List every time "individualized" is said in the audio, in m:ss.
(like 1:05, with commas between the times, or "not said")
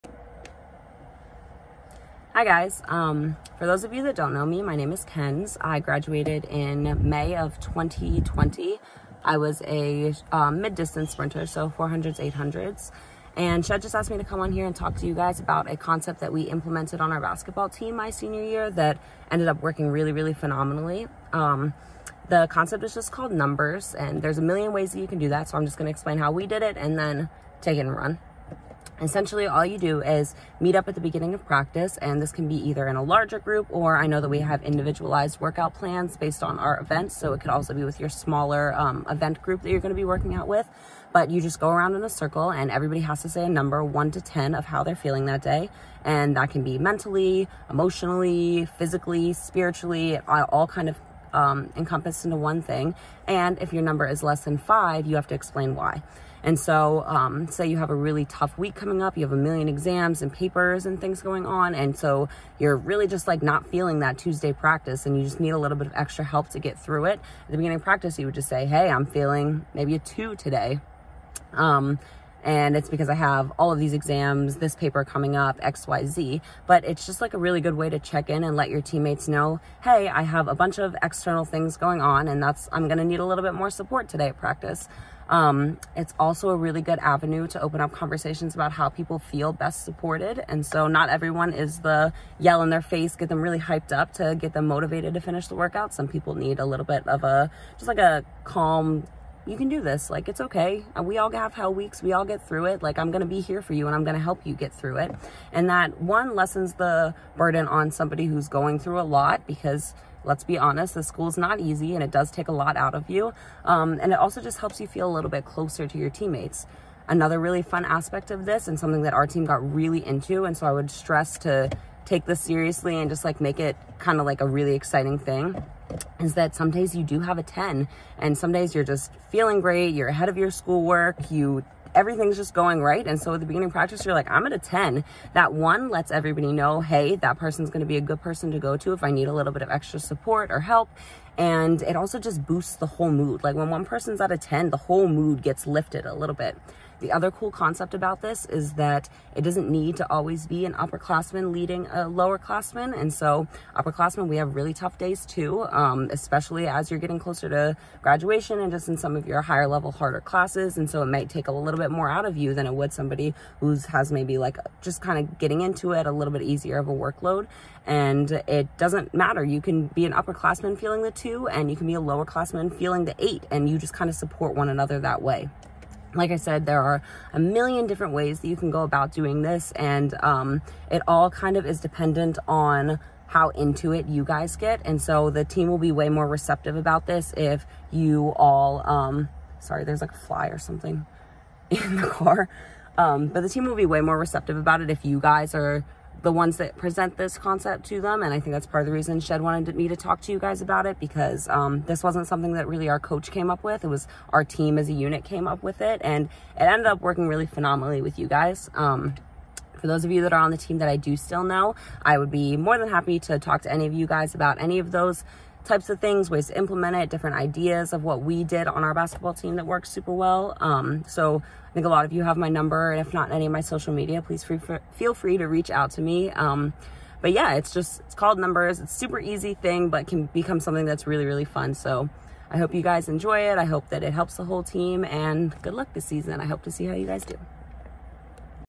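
0:34.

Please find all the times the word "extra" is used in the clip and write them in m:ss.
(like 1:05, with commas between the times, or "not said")
1:05, 2:19.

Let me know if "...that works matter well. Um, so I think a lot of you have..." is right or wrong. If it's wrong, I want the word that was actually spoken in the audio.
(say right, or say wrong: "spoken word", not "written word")
wrong: "super", not "matter".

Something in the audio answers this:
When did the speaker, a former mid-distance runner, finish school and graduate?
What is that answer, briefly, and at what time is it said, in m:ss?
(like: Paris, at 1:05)
May 2020, at 0:07.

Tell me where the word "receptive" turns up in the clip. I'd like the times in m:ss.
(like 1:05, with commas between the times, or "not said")
3:06, 3:14.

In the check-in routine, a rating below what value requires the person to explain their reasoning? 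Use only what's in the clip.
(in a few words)
5.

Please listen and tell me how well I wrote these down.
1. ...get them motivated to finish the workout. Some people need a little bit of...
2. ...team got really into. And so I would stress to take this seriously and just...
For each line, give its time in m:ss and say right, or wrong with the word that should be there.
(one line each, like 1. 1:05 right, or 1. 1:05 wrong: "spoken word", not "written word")
1. 1:34 right
2. 1:59 right.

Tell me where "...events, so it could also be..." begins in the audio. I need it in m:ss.
0:36.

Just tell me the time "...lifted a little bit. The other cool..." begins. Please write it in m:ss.
2:25.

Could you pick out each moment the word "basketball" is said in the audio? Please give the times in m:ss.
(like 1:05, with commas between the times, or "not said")
0:17, 3:38.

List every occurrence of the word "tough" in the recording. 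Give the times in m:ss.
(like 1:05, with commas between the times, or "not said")
0:58, 2:34.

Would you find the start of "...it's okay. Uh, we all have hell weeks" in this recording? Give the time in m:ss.
1:40.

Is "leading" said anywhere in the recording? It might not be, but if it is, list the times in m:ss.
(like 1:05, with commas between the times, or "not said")
2:31.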